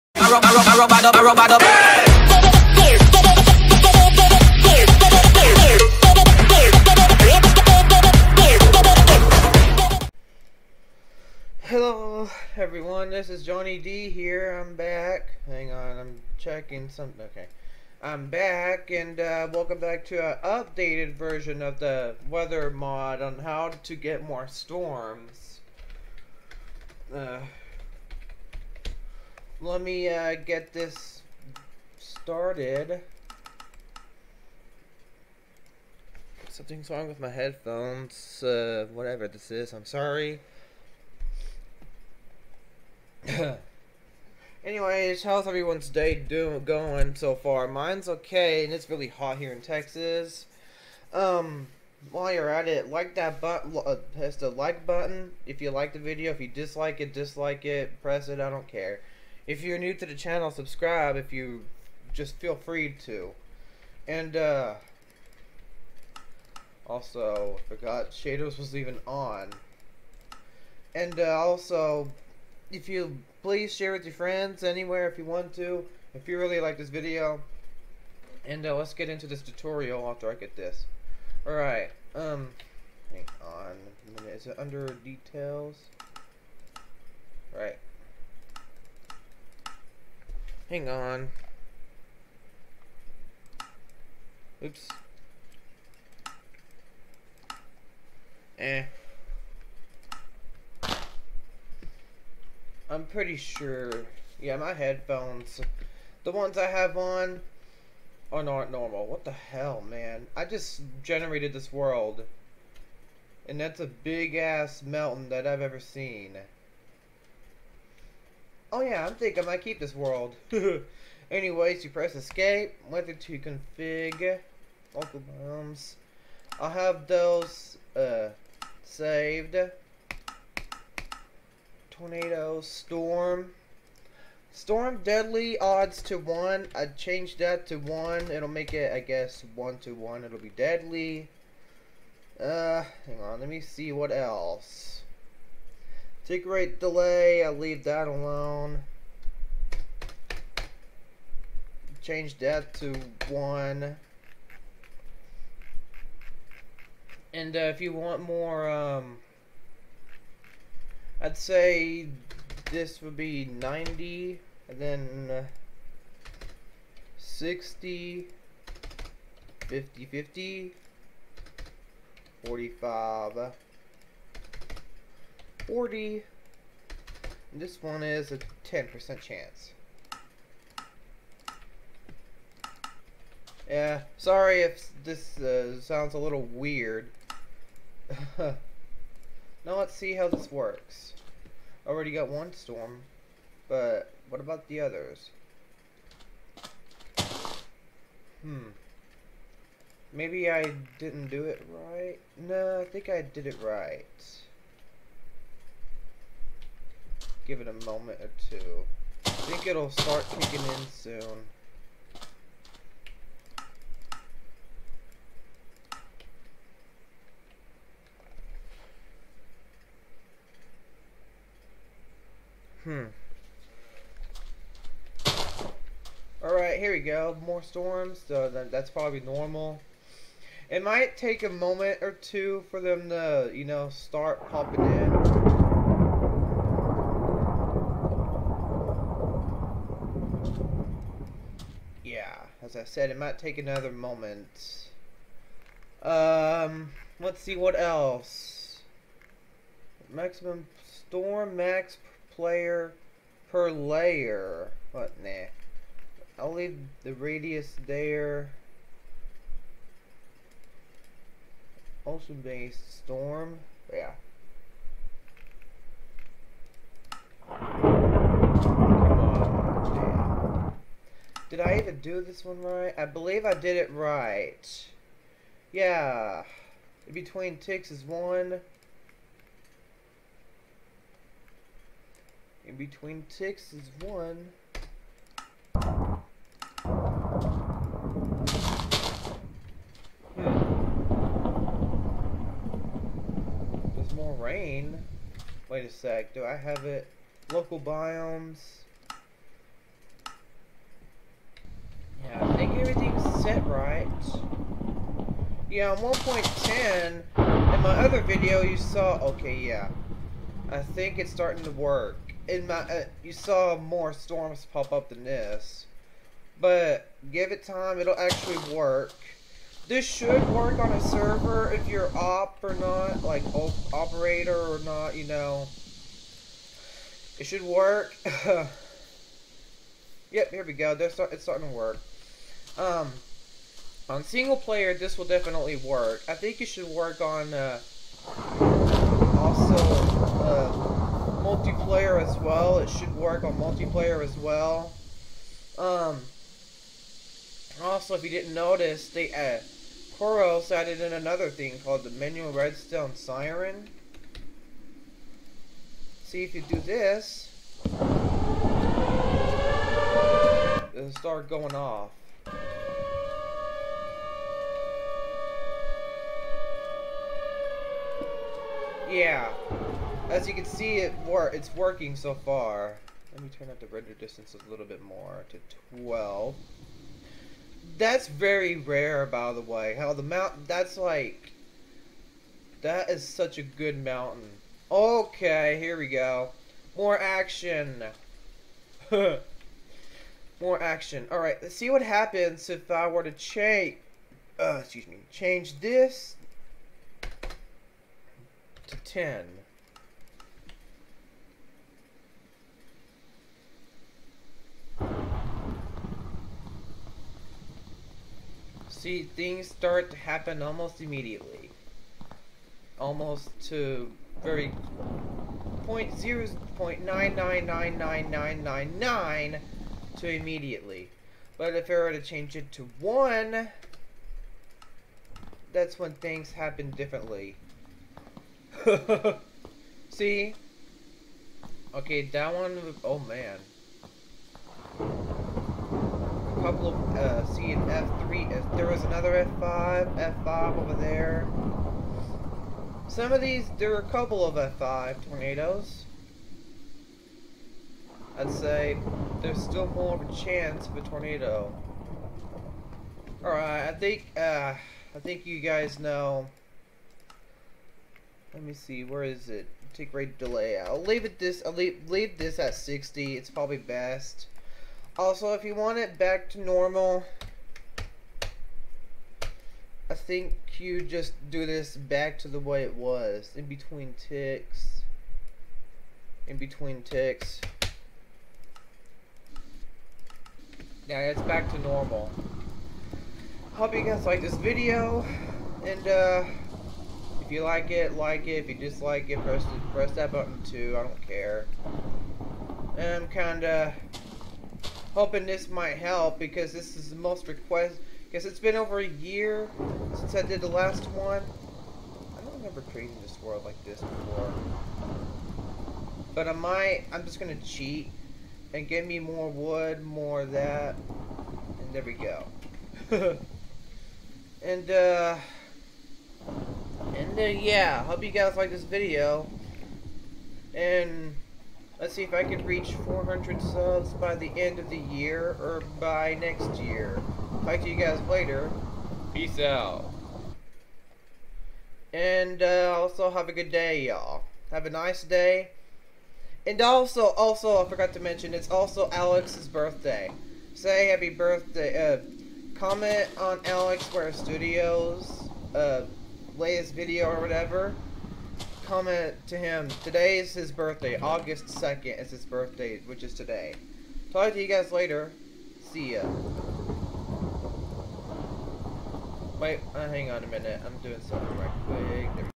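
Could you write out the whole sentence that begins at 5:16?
But give it time, it'll actually work.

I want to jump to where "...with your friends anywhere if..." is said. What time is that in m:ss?
1:13.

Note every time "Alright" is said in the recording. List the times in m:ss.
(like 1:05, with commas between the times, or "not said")
1:21, 3:46, 6:31, 7:33.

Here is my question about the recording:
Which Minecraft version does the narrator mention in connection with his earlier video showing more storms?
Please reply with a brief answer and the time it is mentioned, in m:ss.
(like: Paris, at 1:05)
1.10, at 5:05.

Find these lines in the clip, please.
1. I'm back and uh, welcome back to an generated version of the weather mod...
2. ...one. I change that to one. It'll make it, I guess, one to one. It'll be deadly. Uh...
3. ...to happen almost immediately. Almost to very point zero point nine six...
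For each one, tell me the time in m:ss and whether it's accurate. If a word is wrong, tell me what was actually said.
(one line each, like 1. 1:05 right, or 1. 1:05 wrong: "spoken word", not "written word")
1. 0:18 wrong: "updated", not "generated"
2. 2:16 right
3. 6:50 wrong: "nine", not "six".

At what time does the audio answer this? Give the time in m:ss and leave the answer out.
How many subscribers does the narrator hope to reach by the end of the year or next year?
8:43.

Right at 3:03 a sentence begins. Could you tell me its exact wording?
Yeah, sorry if this uh, sounds a little weird.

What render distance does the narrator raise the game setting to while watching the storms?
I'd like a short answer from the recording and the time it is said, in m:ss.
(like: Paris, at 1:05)
12, at 6:15.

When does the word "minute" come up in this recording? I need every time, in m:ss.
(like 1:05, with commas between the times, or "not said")
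1:24, 9:20.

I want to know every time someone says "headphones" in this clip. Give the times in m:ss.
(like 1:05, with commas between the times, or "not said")
0:37, 1:44.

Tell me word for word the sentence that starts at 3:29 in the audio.
I think it'll start kicking in soon.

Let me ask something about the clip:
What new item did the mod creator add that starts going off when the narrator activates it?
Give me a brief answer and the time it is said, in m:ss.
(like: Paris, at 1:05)
manual redstone siren, at 5:52.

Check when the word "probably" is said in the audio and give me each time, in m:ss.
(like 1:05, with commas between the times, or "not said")
3:48, 7:43.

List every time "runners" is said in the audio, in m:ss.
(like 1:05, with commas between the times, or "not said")
not said.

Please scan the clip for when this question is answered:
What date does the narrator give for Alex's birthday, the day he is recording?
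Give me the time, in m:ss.
9:11.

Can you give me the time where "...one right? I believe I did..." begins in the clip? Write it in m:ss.
4:32.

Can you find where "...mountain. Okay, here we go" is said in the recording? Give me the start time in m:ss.
6:24.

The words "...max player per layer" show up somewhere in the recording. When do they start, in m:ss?
4:11.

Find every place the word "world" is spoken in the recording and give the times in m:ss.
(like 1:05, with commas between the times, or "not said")
1:51, 1:59, 8:23.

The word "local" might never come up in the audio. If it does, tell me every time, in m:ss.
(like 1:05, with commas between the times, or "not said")
2:04, 4:57.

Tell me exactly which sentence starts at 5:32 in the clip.
Um, on single player, this will definitely work.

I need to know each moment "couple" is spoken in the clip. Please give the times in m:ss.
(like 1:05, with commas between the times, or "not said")
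7:16, 7:24.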